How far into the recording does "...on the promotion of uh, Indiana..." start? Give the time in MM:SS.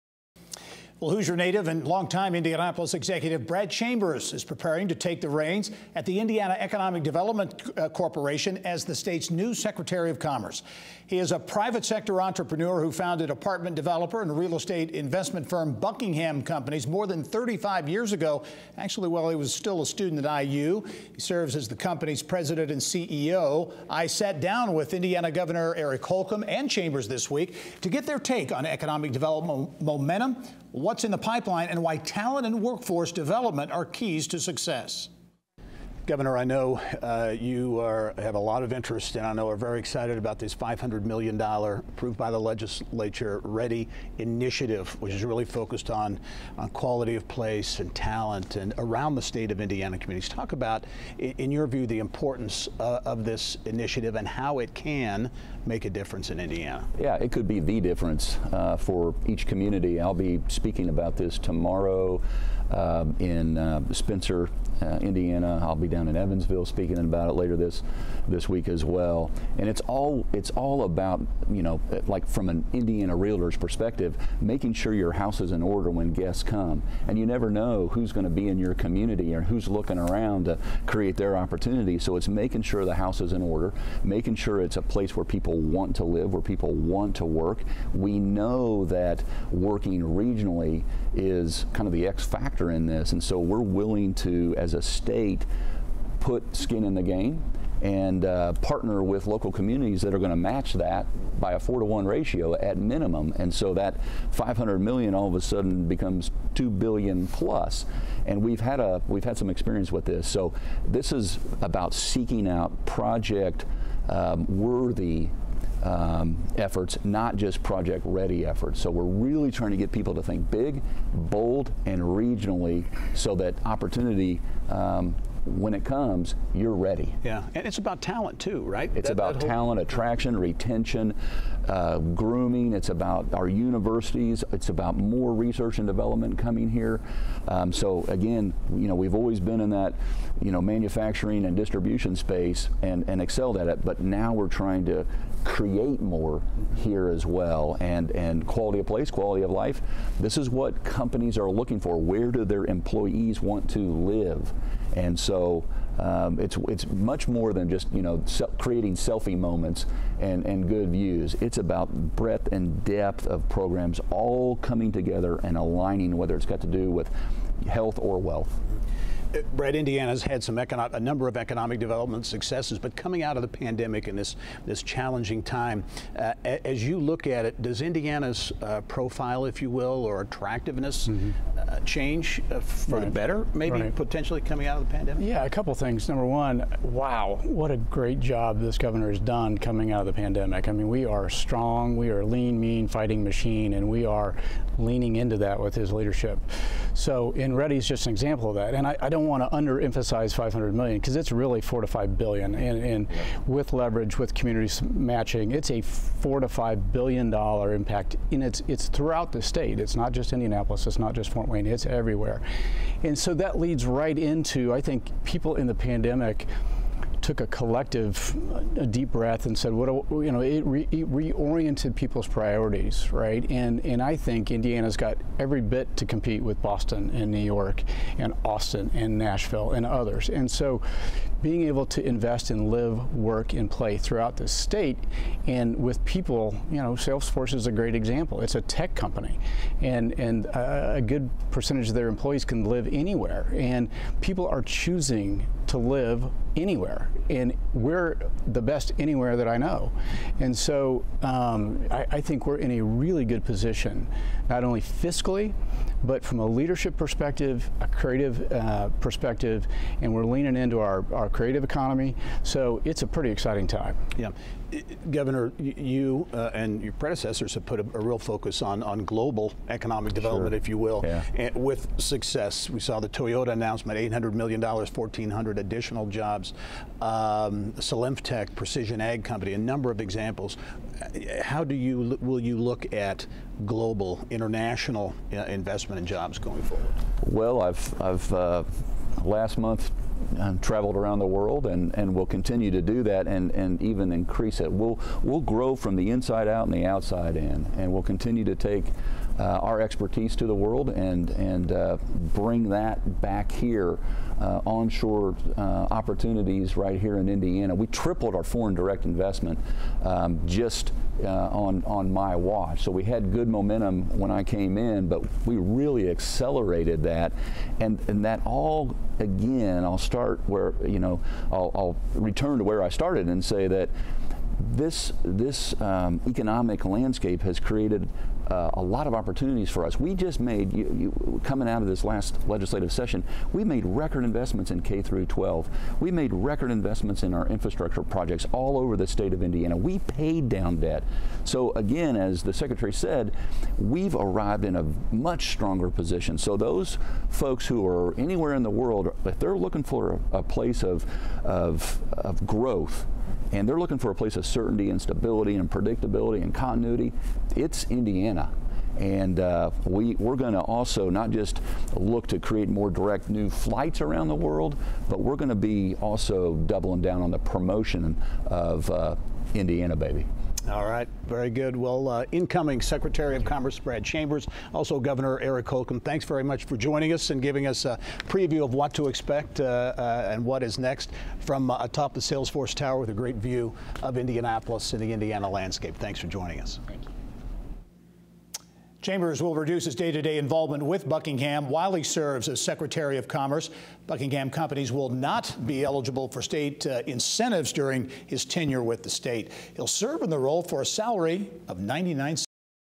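06:07.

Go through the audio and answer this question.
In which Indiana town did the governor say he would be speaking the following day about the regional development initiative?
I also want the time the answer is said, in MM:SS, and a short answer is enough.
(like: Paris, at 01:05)
Spencer, at 01:03.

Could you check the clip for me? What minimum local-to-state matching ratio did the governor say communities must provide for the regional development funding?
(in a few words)
4 to 1.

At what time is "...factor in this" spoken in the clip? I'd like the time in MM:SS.
01:32.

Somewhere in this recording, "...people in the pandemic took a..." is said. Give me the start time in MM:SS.
03:35.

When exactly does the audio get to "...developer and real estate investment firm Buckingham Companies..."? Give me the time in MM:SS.
00:13.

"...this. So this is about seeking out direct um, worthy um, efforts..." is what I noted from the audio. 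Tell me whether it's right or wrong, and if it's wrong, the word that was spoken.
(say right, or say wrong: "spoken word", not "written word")
wrong: "project", not "direct".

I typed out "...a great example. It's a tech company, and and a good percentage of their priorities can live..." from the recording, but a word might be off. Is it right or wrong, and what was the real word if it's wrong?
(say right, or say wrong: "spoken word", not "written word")
wrong: "employees", not "priorities".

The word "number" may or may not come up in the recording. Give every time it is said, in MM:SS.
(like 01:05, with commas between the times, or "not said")
02:50, 03:06, 04:39.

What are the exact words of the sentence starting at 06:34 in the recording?
Buckingham companies will not be eligible for state uh, incentives during his tenure with the state.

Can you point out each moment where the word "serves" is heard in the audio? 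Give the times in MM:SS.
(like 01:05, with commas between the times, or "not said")
00:21, 06:32, 06:39.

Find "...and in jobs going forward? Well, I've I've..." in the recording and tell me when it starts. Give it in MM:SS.
04:45.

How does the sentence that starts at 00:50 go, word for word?
Talk about, in your view, the importance uh, of this initiative and how it can make a difference in Indiana.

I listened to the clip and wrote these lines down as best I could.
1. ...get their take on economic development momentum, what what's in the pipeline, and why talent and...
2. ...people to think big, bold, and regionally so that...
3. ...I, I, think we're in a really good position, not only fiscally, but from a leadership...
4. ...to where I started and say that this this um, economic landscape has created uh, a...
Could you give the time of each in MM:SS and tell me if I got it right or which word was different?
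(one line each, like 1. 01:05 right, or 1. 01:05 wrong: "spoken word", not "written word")
1. 00:27 right
2. 01:59 right
3. 04:11 right
4. 05:22 right.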